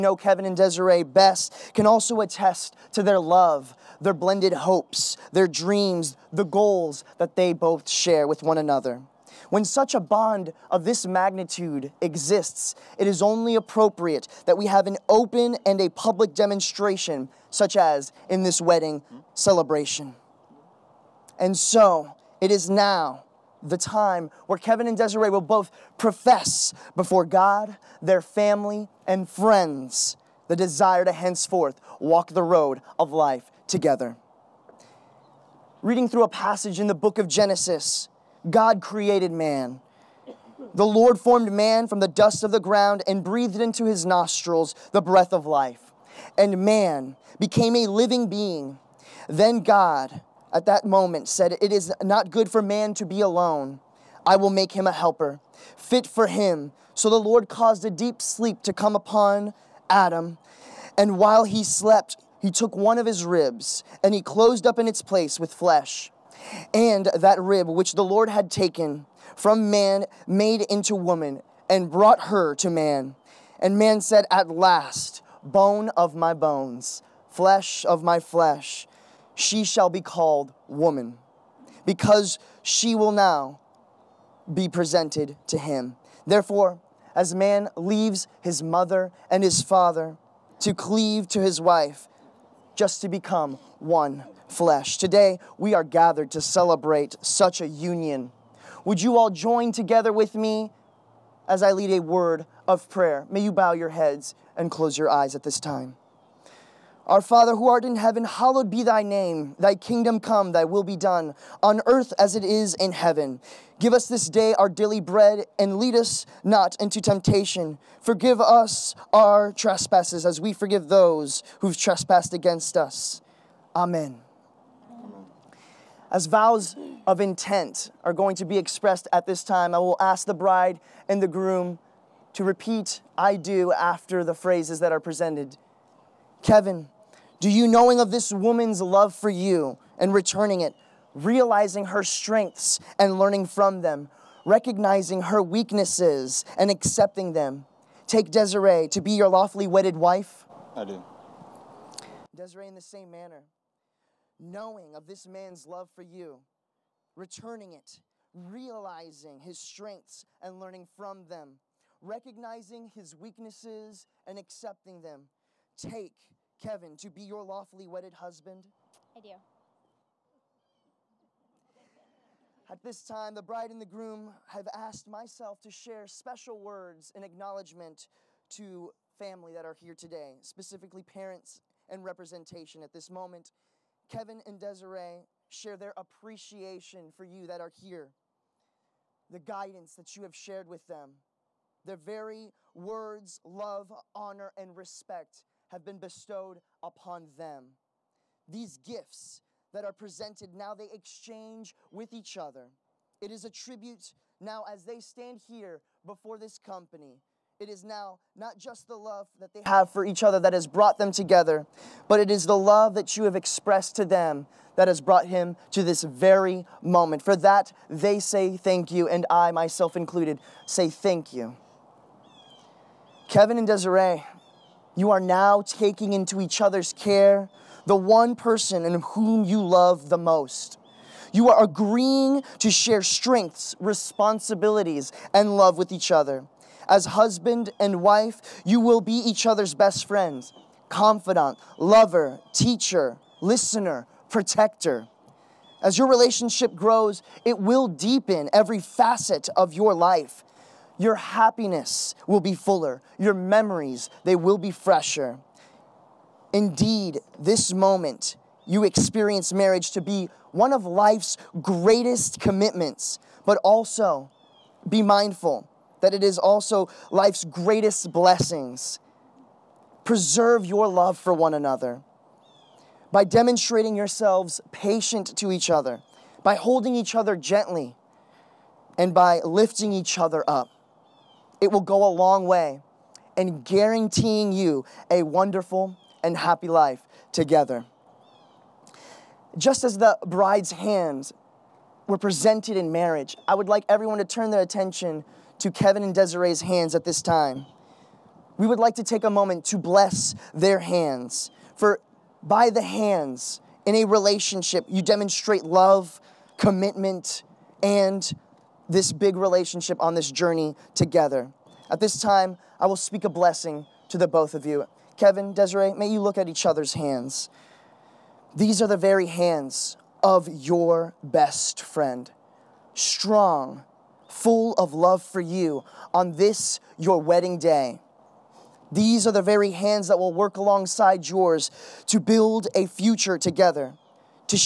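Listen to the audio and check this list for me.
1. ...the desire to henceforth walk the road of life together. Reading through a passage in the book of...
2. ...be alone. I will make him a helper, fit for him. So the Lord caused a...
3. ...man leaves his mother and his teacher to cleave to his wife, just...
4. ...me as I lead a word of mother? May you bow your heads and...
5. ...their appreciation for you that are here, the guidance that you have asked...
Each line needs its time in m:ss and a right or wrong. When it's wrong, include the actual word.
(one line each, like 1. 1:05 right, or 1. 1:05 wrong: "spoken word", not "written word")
1. 0:30 right
2. 0:53 right
3. 1:27 wrong: "father", not "teacher"
4. 1:40 wrong: "prayer", not "mother"
5. 3:05 wrong: "shared", not "asked".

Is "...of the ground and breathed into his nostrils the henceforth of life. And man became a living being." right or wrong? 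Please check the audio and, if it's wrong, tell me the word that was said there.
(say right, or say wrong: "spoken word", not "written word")
wrong: "breath", not "henceforth".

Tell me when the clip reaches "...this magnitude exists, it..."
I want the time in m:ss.
0:10.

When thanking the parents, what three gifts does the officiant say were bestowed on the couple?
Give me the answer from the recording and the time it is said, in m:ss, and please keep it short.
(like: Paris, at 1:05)
love, honor, and respect, at 3:13.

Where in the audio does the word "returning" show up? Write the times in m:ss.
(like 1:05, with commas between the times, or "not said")
2:20, 2:37.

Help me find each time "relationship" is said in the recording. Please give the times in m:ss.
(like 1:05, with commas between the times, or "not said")
4:06, 5:04, 5:09.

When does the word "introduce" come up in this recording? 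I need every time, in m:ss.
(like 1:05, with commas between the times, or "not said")
not said.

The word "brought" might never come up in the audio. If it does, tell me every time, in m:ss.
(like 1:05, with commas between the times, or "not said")
1:11, 3:30, 3:35.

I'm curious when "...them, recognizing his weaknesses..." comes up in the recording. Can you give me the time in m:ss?
2:41.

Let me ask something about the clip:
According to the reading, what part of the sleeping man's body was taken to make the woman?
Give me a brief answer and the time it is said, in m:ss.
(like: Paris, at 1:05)
one of his ribs, at 1:02.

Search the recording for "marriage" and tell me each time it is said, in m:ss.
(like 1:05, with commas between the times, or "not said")
4:19, 4:52.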